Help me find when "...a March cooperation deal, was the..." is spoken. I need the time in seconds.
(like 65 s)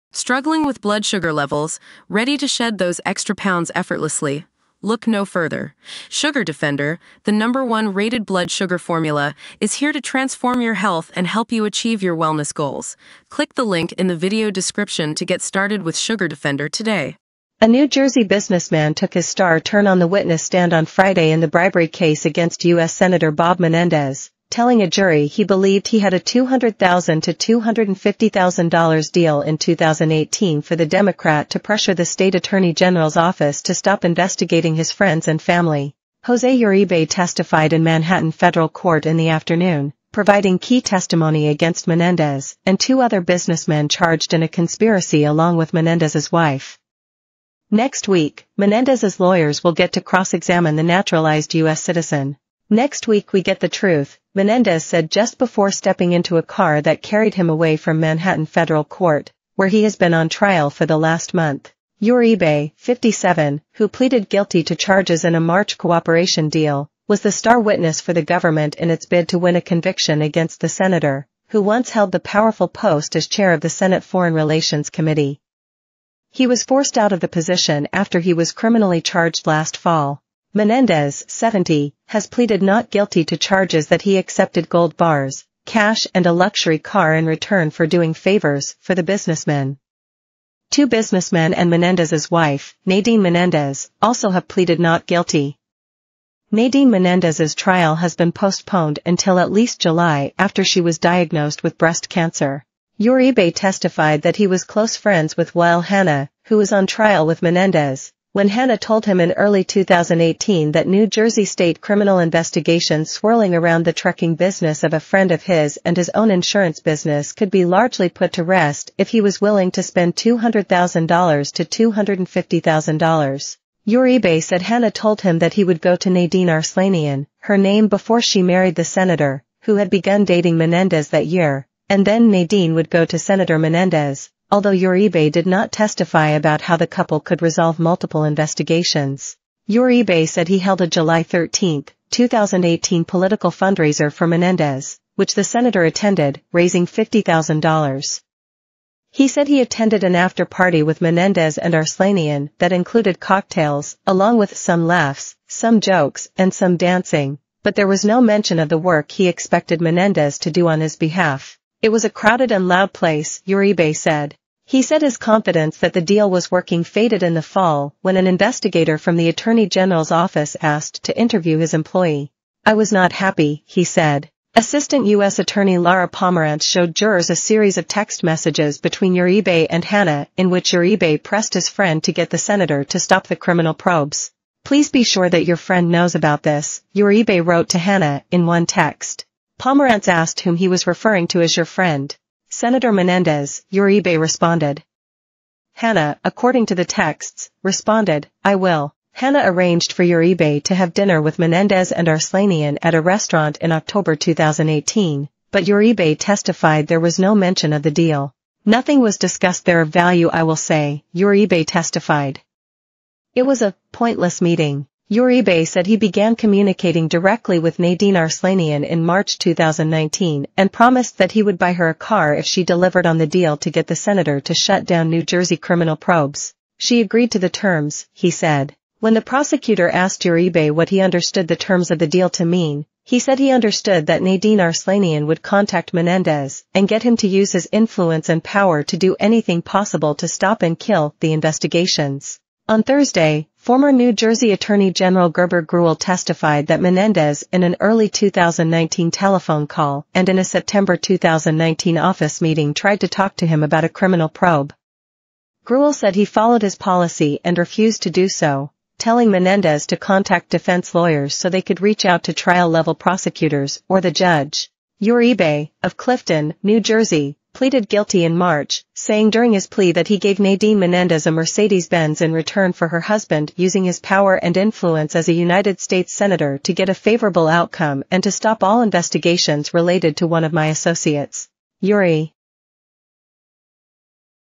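65 s.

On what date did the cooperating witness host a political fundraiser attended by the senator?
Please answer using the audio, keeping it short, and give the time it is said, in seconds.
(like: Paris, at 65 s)
July 13, 2018, at 140 s.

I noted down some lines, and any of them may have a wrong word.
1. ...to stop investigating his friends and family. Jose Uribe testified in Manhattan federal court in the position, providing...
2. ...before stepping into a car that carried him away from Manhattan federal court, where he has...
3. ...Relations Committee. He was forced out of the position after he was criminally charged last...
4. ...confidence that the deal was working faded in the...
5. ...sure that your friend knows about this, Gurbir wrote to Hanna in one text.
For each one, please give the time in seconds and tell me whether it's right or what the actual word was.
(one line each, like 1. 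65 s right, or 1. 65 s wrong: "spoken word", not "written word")
1. 33 s wrong: "afternoon", not "position"
2. 55 s right
3. 74 s right
4. 165 s right
5. 185 s wrong: "Uribe", not "Gurbir".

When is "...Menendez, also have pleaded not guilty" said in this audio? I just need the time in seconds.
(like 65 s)
93 s.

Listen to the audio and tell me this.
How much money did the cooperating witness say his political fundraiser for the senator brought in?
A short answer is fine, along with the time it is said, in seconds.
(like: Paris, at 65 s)
$50,000, at 146 s.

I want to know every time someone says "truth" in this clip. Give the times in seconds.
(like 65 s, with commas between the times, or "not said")
53 s.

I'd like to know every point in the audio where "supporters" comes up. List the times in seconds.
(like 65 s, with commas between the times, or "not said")
not said.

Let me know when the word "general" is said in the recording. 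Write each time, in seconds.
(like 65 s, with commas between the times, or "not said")
32 s, 169 s, 244 s.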